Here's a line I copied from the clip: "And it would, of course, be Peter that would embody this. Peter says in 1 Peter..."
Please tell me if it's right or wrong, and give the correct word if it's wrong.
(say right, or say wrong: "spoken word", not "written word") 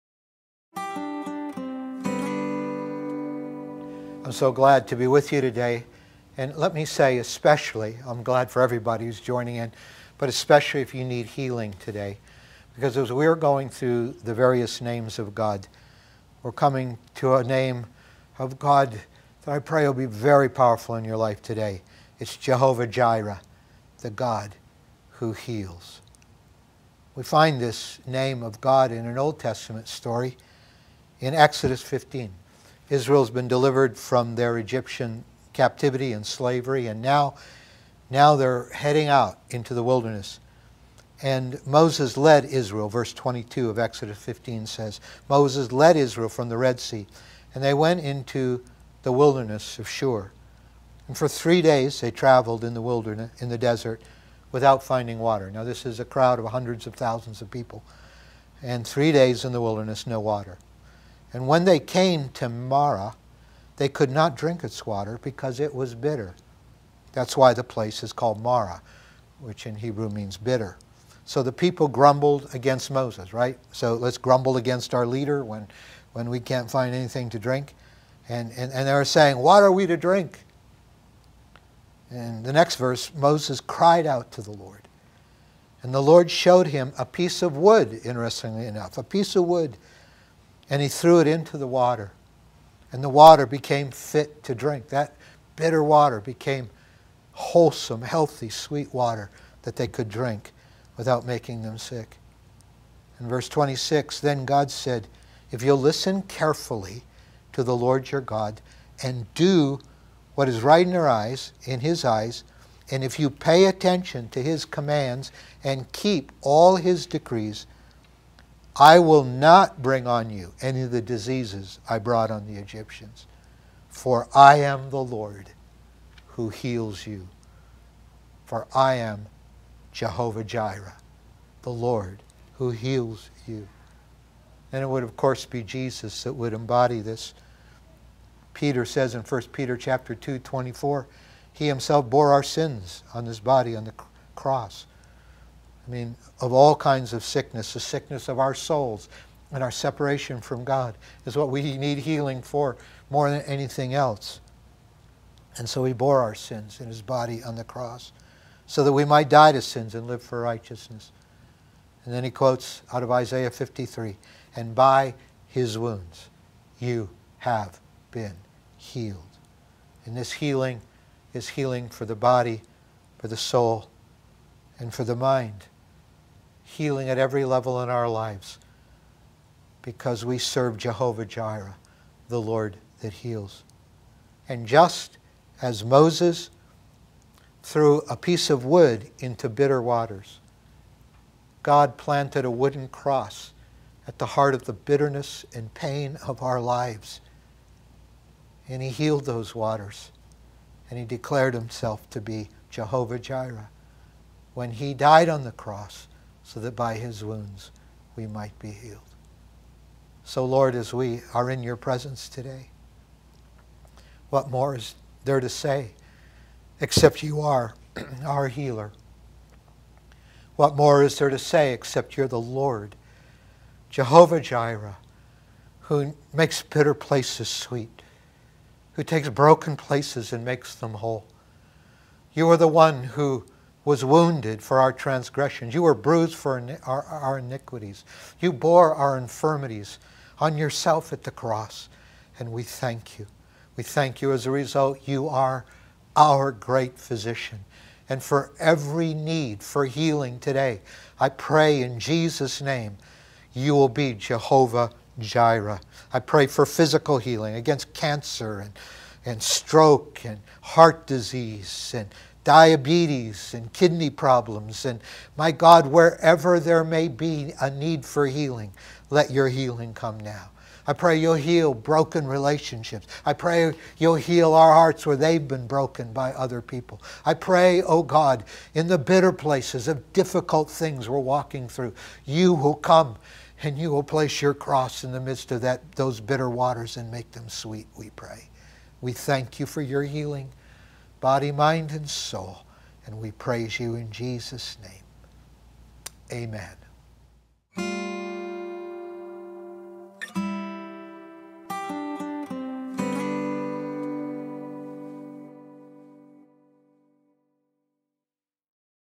wrong: "Jesus", not "Peter".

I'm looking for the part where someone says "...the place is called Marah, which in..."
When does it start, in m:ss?
1:07.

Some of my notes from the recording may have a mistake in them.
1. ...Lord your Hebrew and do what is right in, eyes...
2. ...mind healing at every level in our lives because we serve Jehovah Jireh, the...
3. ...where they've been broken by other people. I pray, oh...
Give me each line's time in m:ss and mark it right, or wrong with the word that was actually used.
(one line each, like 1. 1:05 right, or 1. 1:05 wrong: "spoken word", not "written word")
1. 1:47 wrong: "God", not "Hebrew"
2. 2:55 right
3. 4:35 right.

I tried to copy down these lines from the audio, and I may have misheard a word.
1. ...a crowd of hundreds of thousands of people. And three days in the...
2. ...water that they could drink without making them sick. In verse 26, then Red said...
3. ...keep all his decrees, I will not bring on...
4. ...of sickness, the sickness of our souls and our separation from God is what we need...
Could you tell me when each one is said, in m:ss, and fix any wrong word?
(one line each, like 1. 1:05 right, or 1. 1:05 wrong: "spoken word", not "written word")
1. 0:56 right
2. 1:38 wrong: "God", not "Red"
3. 1:55 right
4. 2:27 right.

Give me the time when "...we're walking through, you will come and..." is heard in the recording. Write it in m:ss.
4:41.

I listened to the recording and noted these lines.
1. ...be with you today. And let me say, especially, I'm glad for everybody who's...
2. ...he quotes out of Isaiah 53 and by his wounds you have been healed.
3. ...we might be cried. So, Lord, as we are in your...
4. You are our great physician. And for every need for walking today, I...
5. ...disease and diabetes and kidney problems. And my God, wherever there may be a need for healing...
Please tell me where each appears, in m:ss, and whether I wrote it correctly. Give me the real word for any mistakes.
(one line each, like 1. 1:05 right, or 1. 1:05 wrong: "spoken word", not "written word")
1. 0:04 right
2. 2:42 right
3. 3:28 wrong: "healed", not "cried"
4. 4:05 wrong: "healing", not "walking"
5. 4:21 right.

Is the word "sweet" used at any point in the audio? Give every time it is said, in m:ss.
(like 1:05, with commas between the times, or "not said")
1:38, 3:47, 4:47.